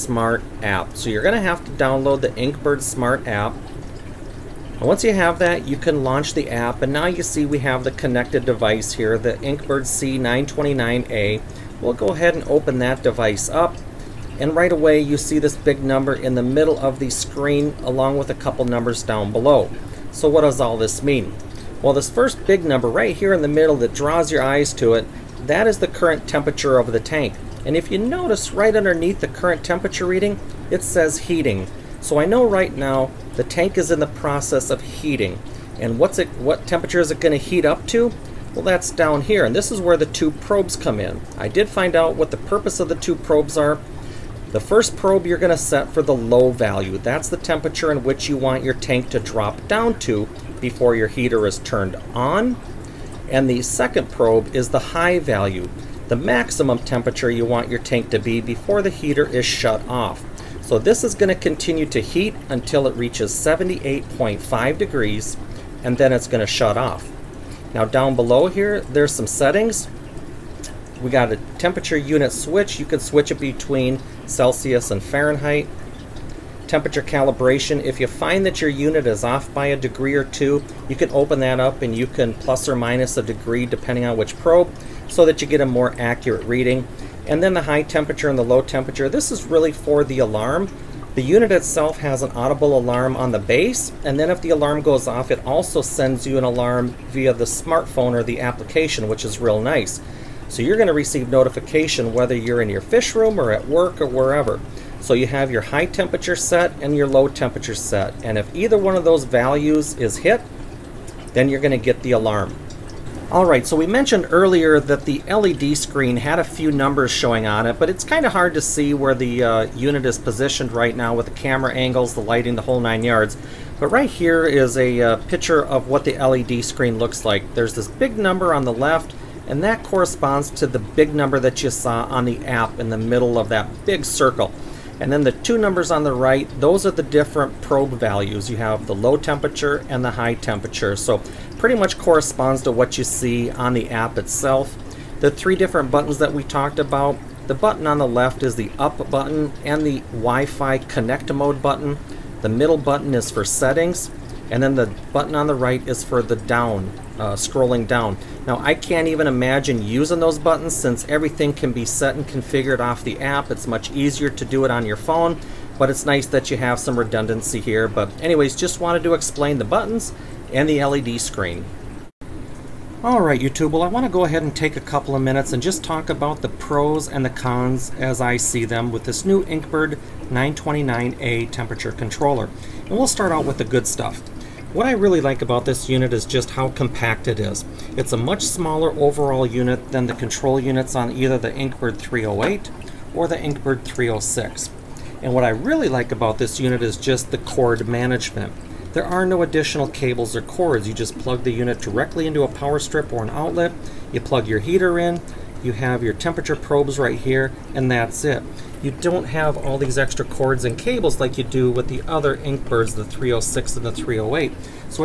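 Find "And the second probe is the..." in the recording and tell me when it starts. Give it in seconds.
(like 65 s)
53 s.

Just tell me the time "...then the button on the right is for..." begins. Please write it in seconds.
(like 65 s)
154 s.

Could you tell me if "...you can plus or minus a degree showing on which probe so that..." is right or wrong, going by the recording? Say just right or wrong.
wrong.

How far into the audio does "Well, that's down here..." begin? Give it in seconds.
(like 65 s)
38 s.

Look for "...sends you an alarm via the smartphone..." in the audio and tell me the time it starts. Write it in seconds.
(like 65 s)
95 s.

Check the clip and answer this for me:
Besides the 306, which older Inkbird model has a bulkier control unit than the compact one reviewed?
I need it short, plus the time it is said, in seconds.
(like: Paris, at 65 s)
Inkbird 308, at 191 s.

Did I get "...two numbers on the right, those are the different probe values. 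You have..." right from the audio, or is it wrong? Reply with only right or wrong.
right.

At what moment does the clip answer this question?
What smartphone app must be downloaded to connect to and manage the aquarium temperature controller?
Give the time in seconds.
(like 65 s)
2 s.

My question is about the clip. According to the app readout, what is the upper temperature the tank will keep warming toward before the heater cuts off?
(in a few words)
78.5 degrees.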